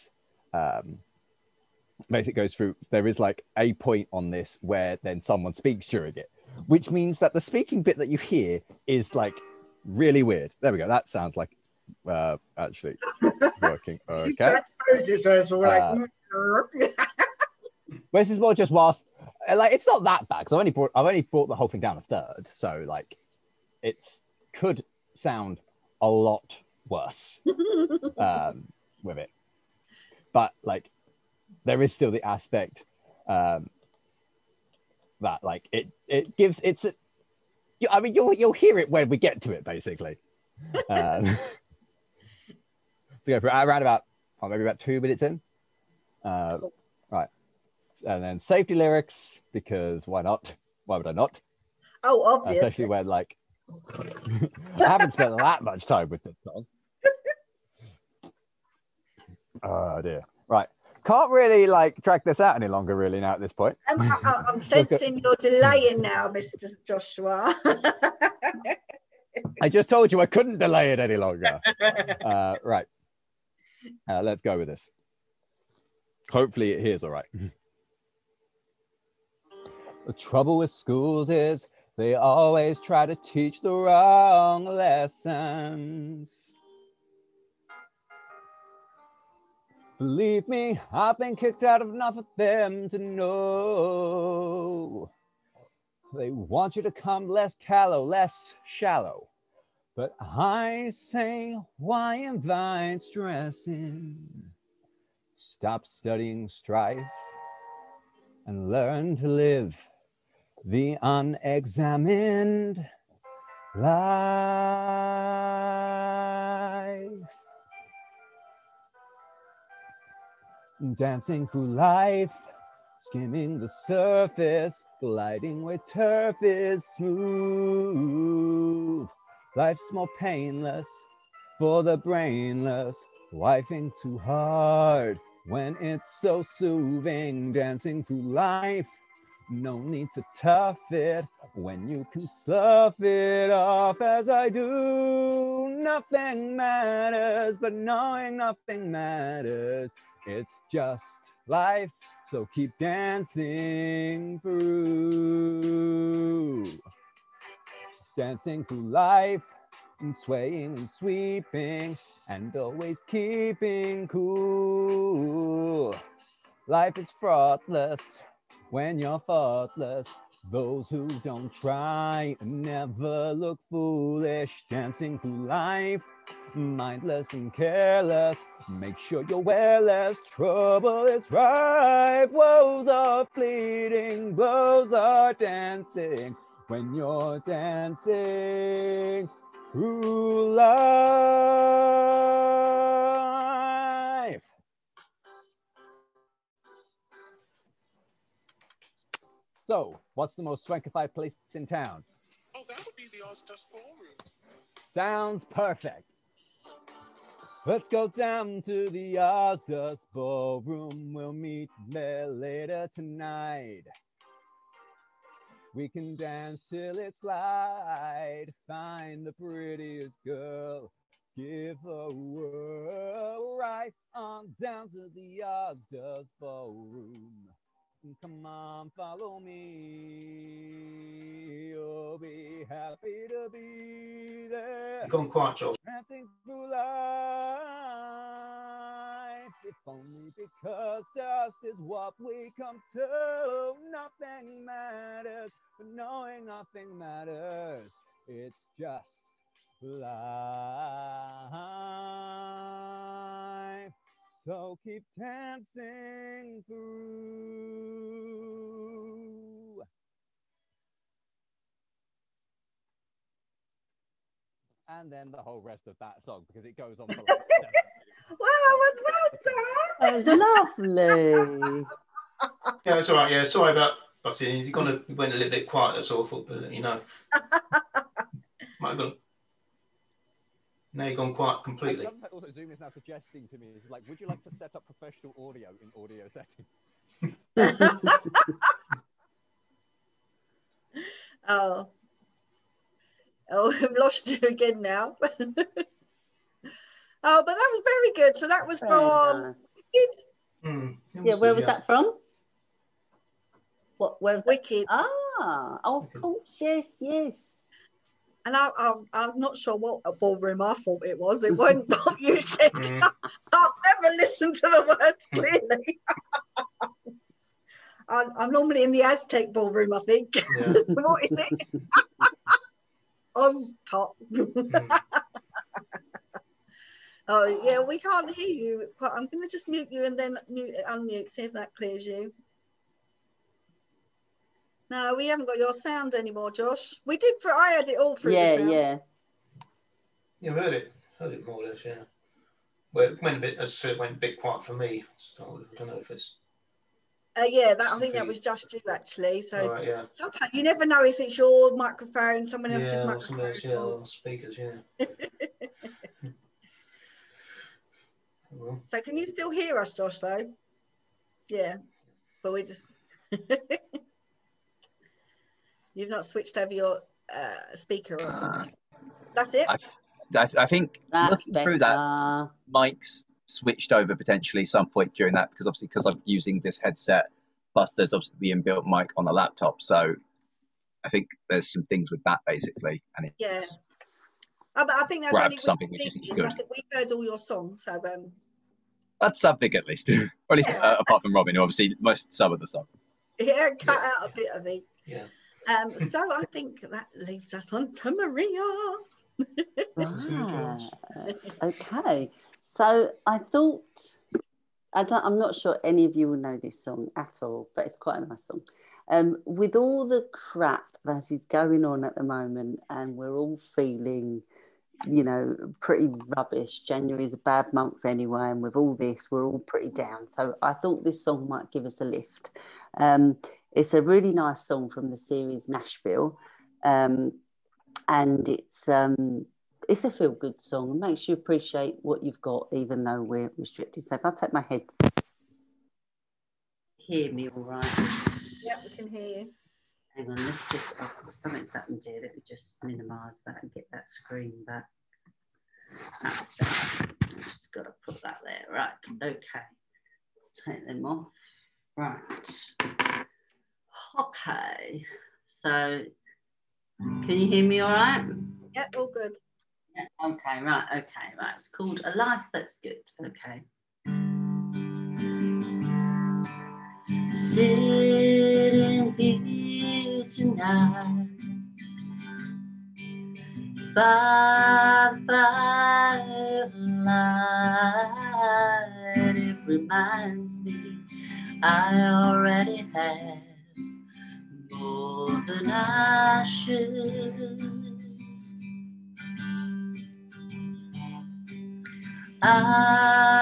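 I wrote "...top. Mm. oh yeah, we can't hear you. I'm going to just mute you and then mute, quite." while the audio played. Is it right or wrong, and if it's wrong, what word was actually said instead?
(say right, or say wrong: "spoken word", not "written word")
wrong: "unmute", not "quite".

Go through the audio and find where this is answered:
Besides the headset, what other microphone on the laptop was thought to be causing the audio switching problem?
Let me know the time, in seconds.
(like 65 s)
378 s.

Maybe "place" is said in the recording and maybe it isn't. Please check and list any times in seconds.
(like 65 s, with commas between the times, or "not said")
201 s.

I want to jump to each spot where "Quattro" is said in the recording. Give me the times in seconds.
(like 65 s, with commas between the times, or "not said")
235 s.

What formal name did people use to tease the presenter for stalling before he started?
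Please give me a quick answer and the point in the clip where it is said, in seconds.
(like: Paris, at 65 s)
Mister Joshua, at 66 s.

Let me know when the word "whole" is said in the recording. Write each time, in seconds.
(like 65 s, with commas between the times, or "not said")
21 s, 265 s.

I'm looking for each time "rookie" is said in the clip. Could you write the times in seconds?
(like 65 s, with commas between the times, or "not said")
not said.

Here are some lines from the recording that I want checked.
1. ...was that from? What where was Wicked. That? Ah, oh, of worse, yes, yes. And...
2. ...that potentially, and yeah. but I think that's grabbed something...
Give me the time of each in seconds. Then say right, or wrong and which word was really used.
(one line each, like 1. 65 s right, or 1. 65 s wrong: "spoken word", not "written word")
1. 301 s wrong: "course", not "worse"
2. 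382 s wrong: "basically", not "potentially".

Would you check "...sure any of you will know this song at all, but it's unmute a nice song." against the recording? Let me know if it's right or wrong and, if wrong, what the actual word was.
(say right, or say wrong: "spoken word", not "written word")
wrong: "quite", not "unmute".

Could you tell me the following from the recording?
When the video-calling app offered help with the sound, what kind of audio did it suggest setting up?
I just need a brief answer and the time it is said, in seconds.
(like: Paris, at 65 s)
professional audio, at 284 s.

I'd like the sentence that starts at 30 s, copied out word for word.
But like, there is still the aspect um, that like it it gives it's.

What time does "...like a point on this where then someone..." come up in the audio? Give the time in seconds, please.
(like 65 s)
3 s.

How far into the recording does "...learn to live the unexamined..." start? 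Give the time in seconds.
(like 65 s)
108 s.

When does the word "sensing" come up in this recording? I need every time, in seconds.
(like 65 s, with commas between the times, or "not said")
64 s.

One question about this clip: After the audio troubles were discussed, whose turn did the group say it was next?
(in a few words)
Maria.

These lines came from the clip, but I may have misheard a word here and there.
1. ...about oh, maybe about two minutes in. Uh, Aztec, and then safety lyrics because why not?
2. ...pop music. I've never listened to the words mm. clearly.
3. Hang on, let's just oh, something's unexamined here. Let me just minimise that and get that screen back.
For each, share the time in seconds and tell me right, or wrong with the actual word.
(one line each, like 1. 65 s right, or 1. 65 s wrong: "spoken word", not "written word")
1. 43 s wrong: "Right", not "Aztec"
2. 311 s right
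3. 440 s wrong: "happened", not "unexamined".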